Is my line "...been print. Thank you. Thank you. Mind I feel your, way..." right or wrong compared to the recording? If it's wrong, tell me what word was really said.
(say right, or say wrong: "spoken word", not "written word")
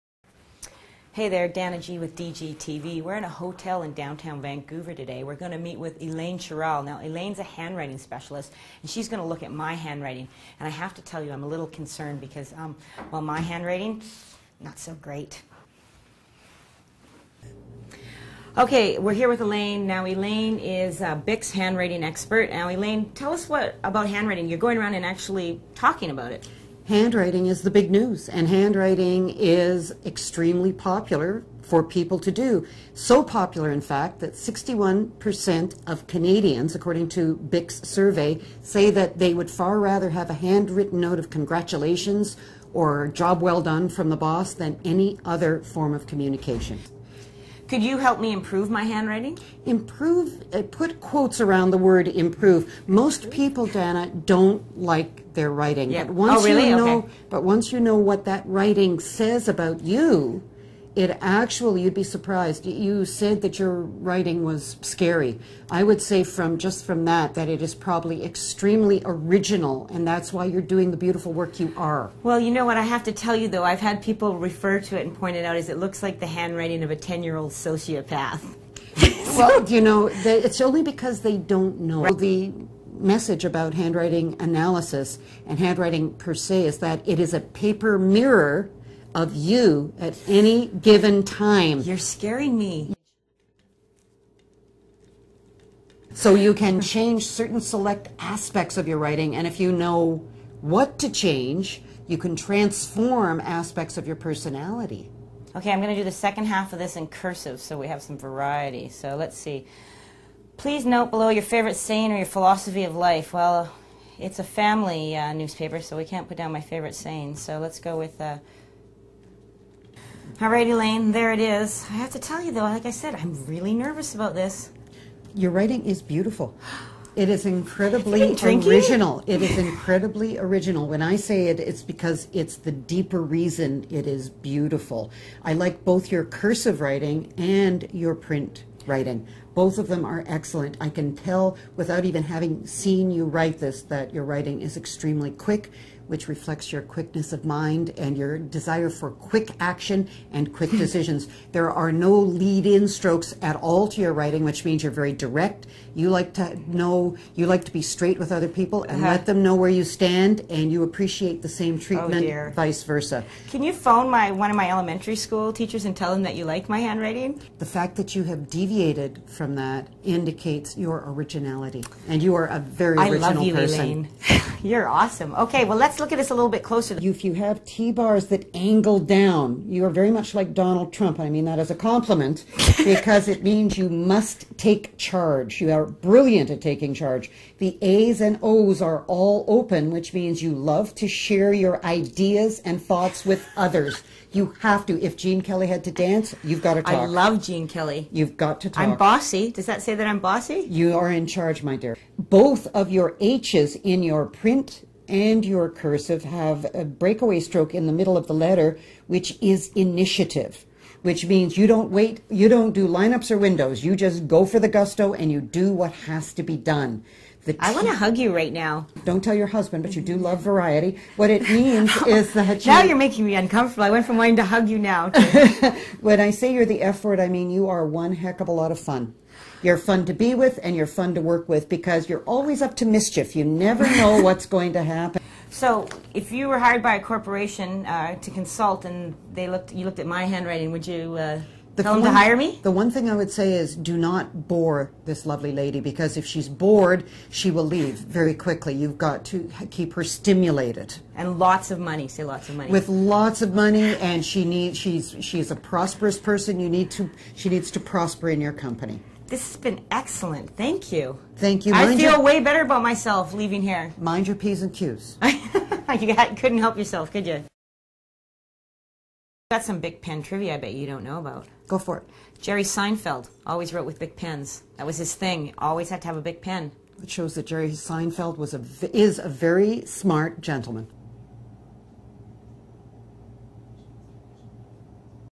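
wrong: "excellent", not "print".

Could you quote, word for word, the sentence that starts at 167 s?
The fact that you have deviated from that indicates your originality.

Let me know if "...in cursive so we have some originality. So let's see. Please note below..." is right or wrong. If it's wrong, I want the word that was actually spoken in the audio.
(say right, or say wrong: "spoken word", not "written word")
wrong: "variety", not "originality".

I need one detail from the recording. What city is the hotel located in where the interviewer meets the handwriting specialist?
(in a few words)
Vancouver.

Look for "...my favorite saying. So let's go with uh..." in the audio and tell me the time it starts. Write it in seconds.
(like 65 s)
116 s.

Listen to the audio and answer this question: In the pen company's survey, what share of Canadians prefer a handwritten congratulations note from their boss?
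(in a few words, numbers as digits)
61%.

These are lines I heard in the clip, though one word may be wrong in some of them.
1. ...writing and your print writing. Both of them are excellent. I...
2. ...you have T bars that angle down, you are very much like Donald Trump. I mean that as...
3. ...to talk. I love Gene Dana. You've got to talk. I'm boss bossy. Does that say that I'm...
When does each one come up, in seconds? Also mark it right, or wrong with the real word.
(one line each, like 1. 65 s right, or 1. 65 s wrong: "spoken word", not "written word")
1. 136 s right
2. 177 s right
3. 196 s wrong: "Kelly", not "Dana".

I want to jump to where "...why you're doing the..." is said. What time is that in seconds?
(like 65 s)
70 s.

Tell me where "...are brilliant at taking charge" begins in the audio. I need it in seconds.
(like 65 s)
185 s.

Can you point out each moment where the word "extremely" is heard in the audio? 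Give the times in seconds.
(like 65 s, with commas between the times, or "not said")
30 s, 68 s, 144 s.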